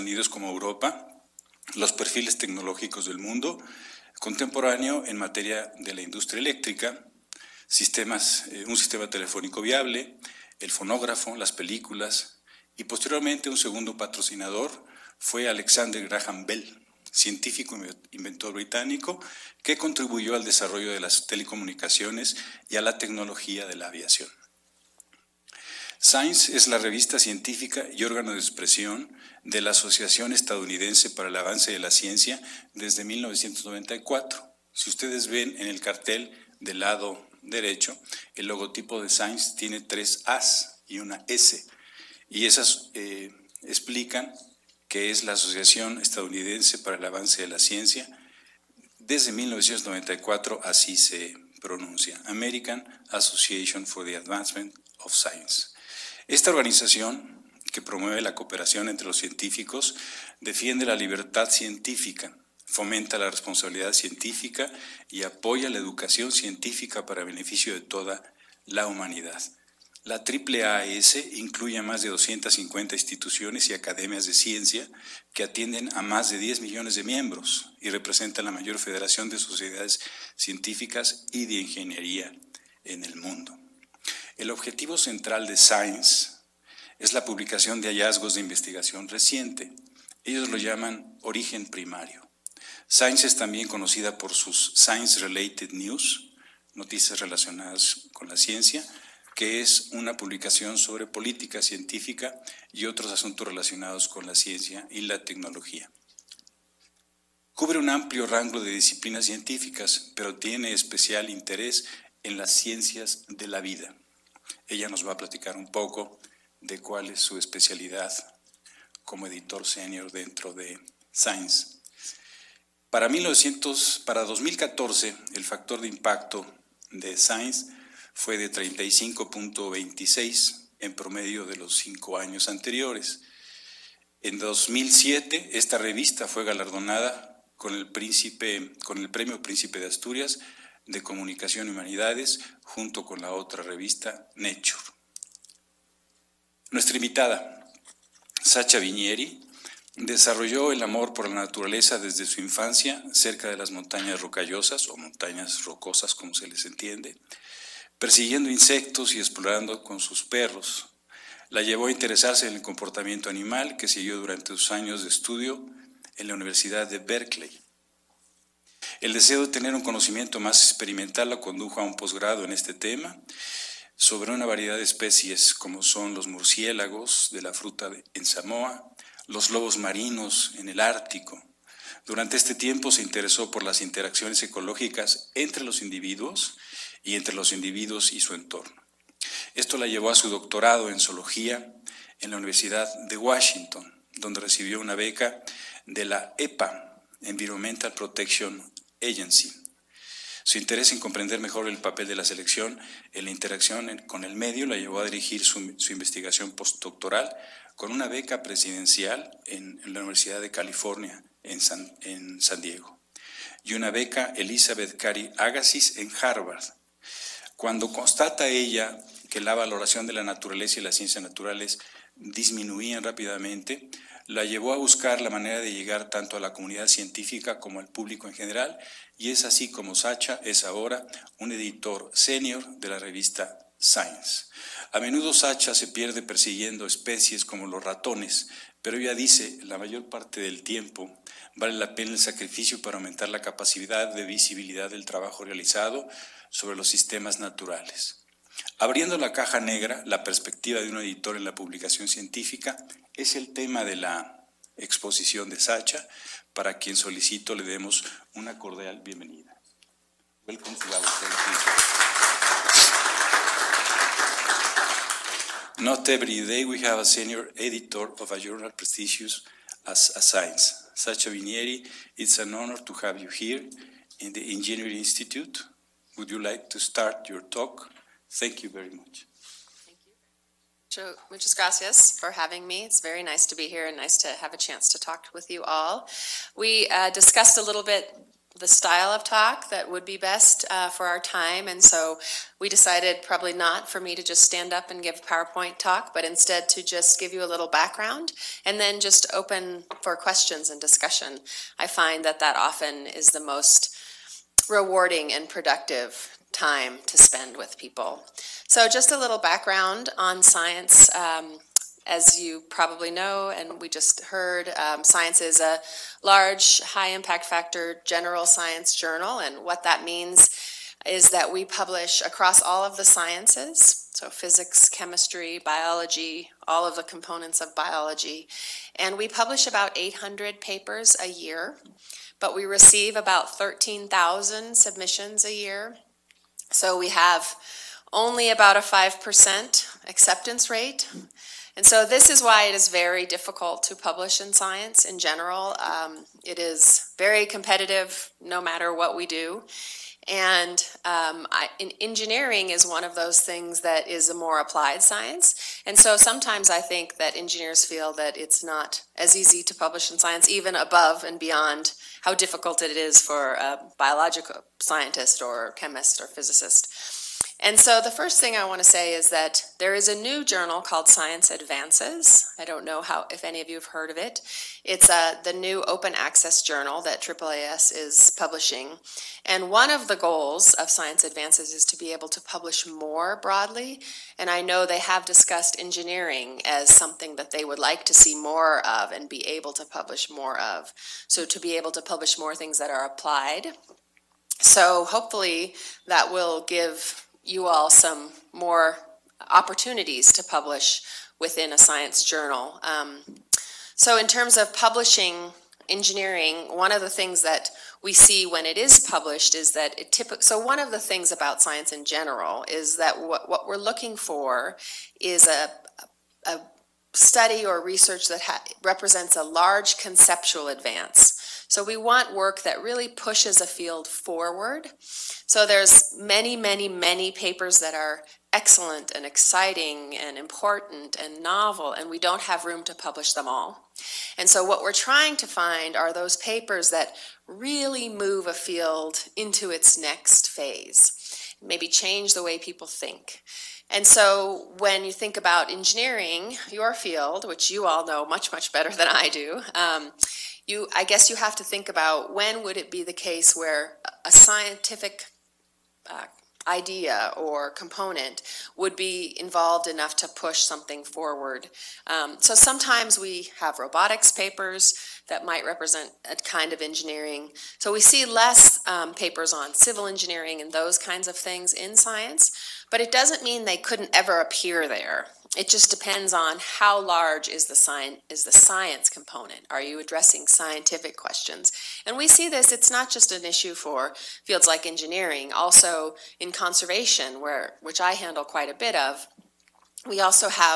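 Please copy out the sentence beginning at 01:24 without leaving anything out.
El objetivo central de Science es la publicación de hallazgos de investigación reciente.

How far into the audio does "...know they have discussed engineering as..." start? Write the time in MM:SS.
06:24.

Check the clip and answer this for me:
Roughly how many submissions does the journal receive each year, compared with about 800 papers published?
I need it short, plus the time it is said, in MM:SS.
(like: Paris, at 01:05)
13,000, at 05:33.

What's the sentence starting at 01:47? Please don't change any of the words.
Cubre un amplio rango de disciplinas científicas, pero tiene especial interés en las ciencias de la vida.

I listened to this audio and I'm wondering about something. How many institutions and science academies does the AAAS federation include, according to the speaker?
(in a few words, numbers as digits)
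more than 250.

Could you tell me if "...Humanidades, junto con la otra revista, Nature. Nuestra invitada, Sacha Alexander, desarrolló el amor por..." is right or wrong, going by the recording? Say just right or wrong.
wrong.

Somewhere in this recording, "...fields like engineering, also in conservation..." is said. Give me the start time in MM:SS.
08:04.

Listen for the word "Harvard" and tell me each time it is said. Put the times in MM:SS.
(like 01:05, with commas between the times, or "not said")
03:36.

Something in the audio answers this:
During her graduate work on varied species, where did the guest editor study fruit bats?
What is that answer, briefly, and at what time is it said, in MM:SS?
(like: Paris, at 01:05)
Samoa, at 02:58.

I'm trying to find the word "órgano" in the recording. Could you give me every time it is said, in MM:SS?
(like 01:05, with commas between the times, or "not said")
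00:28.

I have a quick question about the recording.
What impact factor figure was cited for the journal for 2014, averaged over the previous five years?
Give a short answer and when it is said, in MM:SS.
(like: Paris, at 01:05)
35.26, at 02:08.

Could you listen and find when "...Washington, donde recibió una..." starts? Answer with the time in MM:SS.
03:13.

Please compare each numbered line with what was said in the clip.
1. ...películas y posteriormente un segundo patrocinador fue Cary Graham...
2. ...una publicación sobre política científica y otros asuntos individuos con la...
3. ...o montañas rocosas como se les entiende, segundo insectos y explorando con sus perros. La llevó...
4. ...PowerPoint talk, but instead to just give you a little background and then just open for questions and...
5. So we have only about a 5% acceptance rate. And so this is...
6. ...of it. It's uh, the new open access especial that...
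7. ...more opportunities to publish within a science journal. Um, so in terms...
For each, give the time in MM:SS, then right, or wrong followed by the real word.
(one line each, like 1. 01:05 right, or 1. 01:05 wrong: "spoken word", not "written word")
1. 00:11 wrong: "Alexander", not "Cary"
2. 01:39 wrong: "relacionados", not "individuos"
3. 02:34 wrong: "persiguiendo", not "segundo"
4. 04:55 right
5. 05:36 right
6. 06:14 wrong: "journal", not "especial"
7. 06:38 right.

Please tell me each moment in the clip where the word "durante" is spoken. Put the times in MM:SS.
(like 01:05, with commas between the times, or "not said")
02:44, 03:02.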